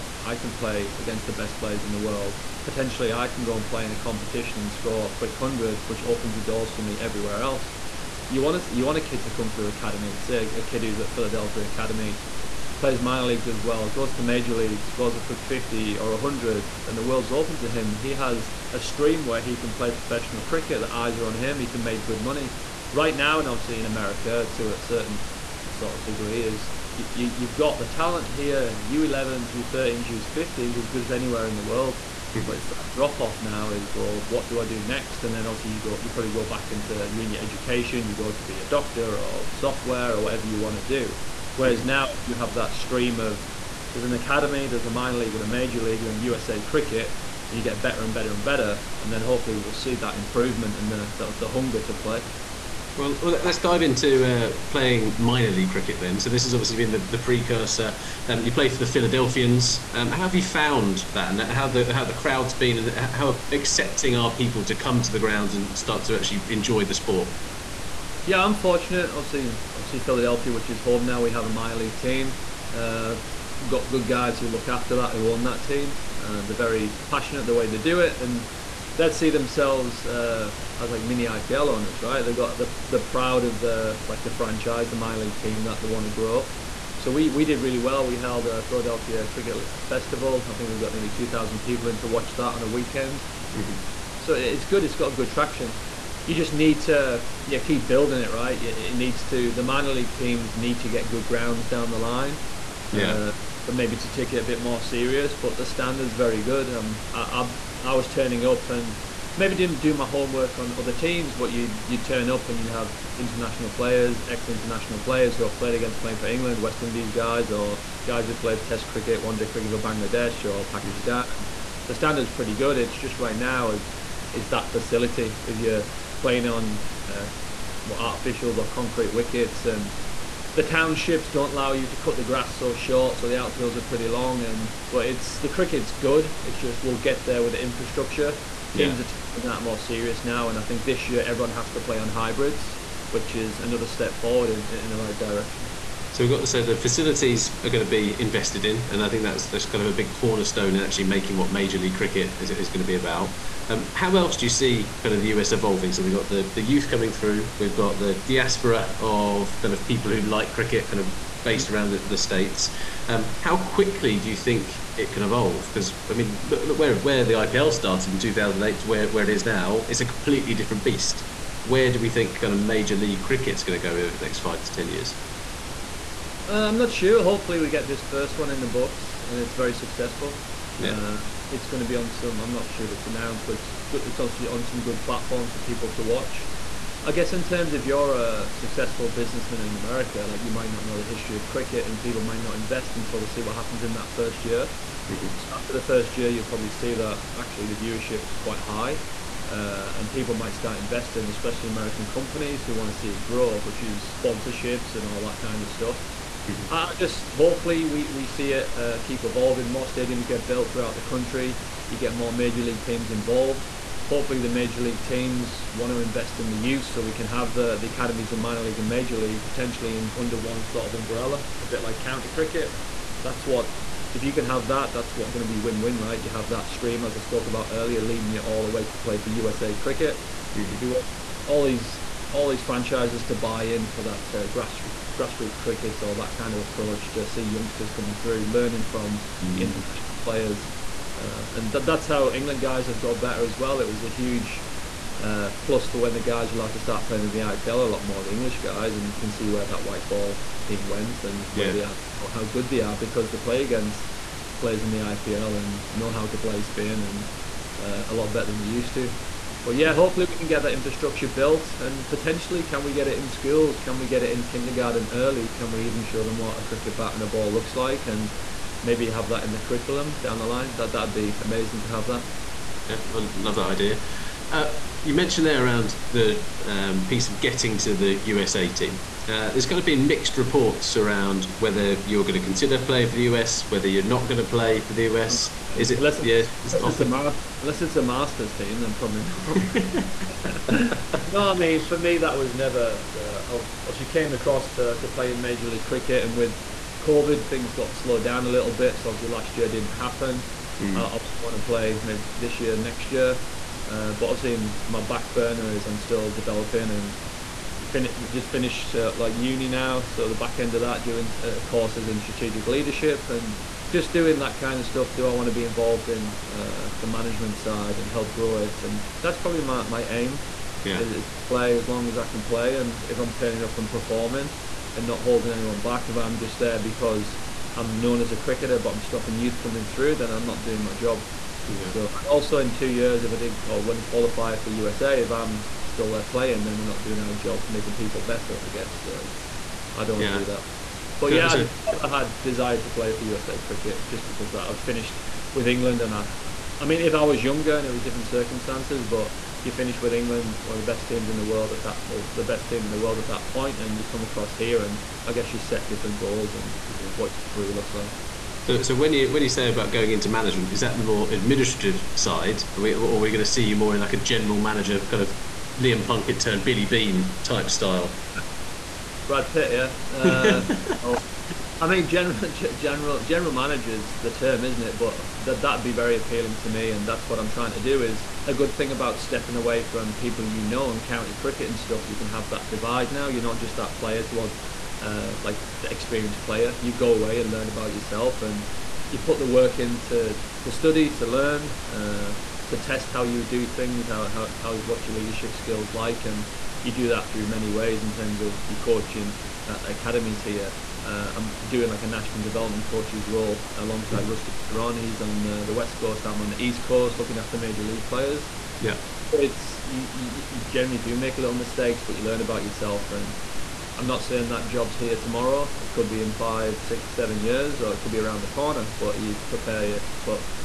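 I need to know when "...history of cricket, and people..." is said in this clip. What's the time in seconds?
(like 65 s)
191 s.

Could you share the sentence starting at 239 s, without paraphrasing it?
international players uh, and th- that's how England guys have got better as well.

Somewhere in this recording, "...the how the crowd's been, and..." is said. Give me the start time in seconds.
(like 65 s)
61 s.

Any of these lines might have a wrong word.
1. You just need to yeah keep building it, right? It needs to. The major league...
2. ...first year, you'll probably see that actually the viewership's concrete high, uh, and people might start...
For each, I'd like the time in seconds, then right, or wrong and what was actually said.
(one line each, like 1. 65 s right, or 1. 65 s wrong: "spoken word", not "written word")
1. 96 s wrong: "minor", not "major"
2. 195 s wrong: "quite", not "concrete".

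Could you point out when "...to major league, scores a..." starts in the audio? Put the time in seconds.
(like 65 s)
14 s.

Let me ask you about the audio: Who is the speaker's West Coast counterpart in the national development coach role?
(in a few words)
Rusty Theron.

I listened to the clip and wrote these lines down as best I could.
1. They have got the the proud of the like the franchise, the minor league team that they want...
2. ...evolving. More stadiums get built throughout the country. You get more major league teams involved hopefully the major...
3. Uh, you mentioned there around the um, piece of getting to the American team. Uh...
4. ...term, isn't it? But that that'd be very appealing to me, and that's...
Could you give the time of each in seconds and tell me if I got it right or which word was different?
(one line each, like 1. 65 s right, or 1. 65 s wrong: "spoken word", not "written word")
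1. 82 s right
2. 209 s right
3. 274 s wrong: "USA", not "American"
4. 374 s right.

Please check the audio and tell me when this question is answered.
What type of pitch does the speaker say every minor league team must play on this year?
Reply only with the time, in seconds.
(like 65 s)
142 s.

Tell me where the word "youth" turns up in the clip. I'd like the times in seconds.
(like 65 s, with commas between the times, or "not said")
156 s, 216 s, 329 s.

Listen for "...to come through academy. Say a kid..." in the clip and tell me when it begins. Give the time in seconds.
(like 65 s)
9 s.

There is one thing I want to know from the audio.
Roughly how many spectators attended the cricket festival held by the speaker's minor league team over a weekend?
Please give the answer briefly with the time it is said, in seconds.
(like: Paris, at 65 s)
2000, at 90 s.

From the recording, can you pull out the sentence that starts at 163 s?
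Um, how quickly do you think it can evolve?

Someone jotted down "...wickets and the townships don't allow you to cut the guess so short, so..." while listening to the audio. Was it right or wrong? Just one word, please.
wrong.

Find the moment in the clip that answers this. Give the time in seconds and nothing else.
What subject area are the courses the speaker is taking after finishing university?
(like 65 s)
312 s.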